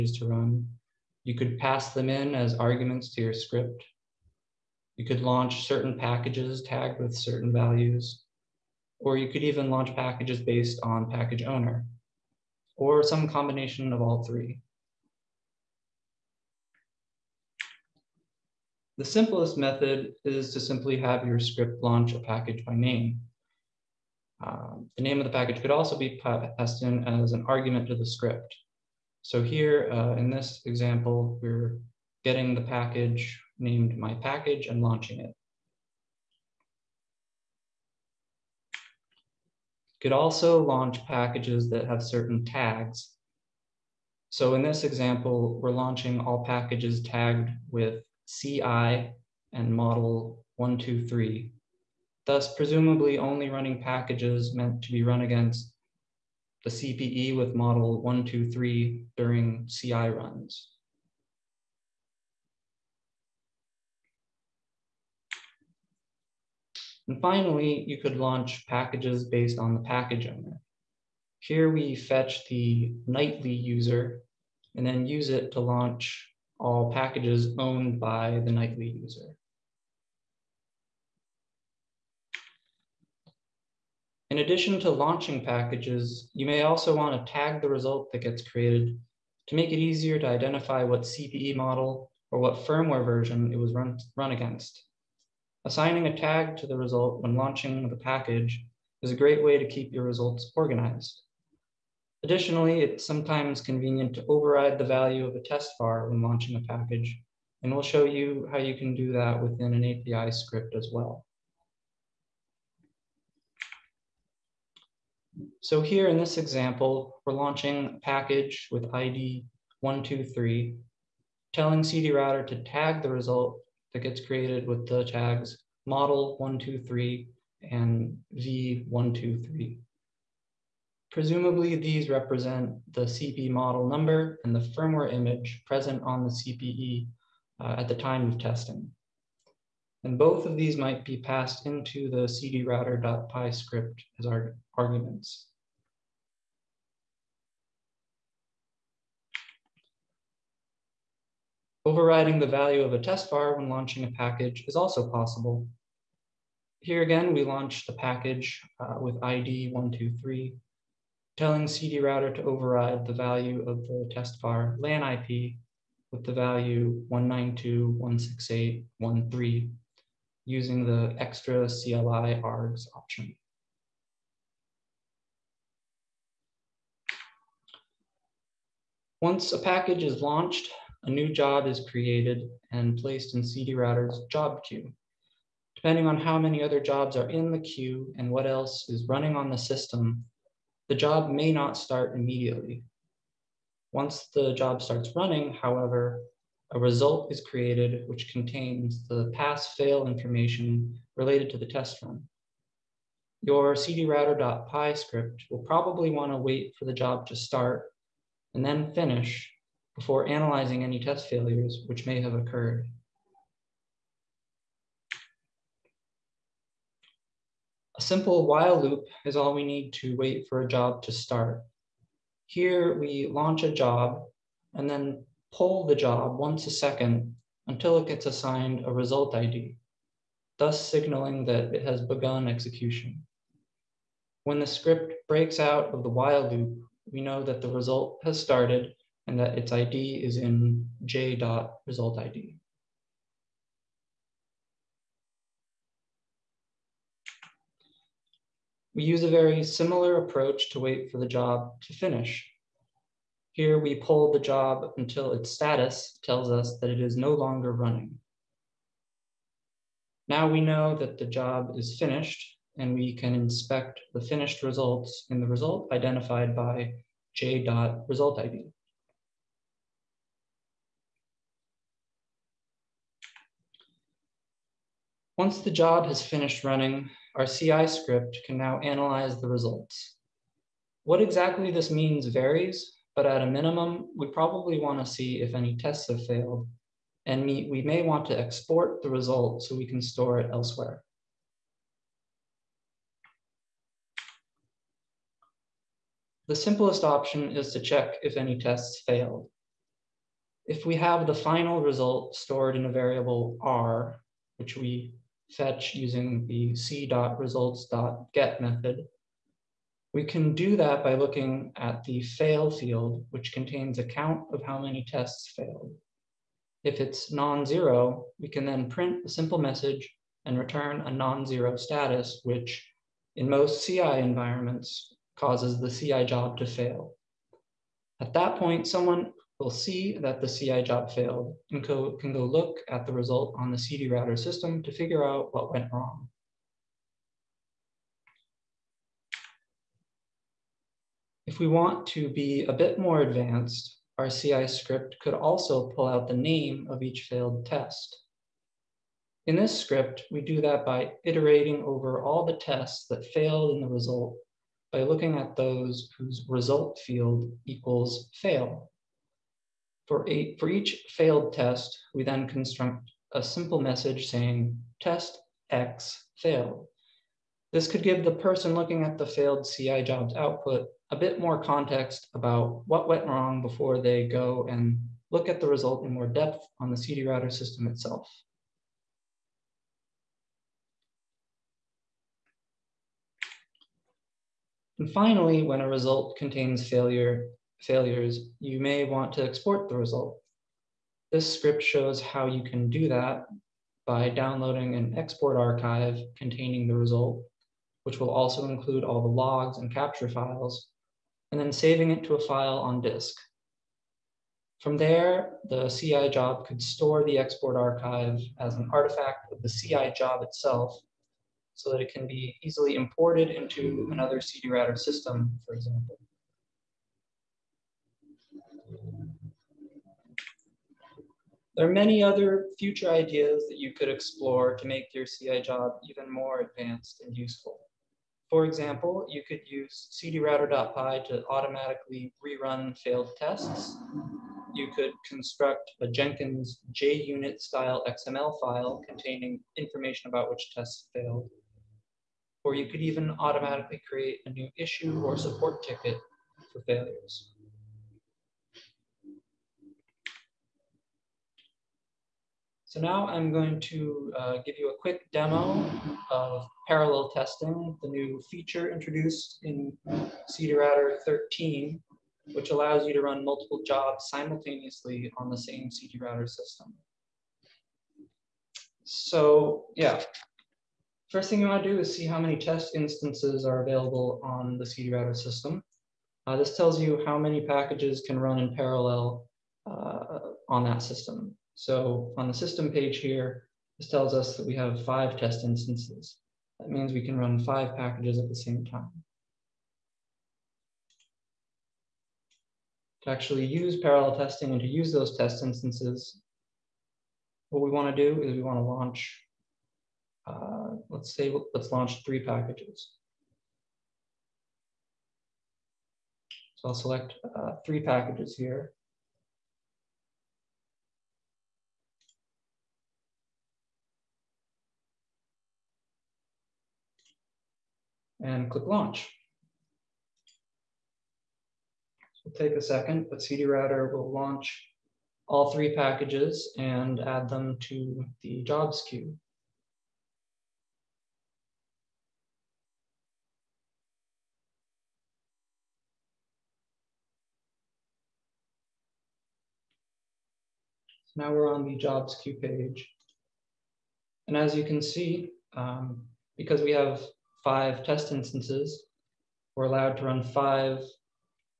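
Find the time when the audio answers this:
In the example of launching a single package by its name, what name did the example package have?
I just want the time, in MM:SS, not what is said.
00:33.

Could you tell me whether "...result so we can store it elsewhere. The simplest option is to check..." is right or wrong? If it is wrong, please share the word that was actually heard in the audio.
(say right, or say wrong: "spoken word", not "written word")
right.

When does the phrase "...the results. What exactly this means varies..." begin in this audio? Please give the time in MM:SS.
04:39.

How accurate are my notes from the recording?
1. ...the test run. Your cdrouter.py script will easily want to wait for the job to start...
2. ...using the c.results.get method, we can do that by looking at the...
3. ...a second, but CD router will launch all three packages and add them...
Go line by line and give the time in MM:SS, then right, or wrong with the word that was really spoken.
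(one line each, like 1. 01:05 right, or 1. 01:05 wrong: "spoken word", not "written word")
1. 03:21 wrong: "probably", not "easily"
2. 05:05 right
3. 08:42 right.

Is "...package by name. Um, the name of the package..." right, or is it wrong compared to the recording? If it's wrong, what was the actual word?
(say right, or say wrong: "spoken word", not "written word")
right.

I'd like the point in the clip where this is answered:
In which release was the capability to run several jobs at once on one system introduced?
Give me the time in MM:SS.
07:40.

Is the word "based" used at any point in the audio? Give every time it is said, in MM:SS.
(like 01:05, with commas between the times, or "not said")
00:10, 01:09.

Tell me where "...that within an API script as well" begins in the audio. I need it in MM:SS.
01:49.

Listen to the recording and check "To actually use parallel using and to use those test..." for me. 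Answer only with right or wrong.
wrong.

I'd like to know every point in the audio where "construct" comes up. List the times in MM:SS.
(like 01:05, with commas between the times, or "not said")
06:02, 07:15.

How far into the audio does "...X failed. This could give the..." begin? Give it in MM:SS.
06:05.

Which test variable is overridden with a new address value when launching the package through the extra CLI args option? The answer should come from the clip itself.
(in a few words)
LAN IP.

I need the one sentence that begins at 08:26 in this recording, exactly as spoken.
So I'll select uh, three packages here.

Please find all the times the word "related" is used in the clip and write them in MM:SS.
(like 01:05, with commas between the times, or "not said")
03:21.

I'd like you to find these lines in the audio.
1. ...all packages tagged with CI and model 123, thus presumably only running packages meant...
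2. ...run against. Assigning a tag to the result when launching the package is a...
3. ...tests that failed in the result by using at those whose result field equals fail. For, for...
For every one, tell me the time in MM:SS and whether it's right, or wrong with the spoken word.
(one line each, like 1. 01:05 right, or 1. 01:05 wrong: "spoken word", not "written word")
1. 00:46 right
2. 01:34 right
3. 05:52 wrong: "looking", not "using".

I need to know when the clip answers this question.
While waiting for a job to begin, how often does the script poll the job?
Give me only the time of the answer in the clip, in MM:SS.
03:46.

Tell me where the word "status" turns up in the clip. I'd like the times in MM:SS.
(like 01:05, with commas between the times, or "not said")
04:15, 05:21.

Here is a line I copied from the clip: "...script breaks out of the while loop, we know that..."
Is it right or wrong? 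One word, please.
right.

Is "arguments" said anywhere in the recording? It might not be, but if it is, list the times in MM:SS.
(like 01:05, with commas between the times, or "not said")
00:02, 00:27, 02:24.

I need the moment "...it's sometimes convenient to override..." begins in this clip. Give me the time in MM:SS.
01:42.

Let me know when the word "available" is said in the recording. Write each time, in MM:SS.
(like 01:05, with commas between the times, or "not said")
07:53.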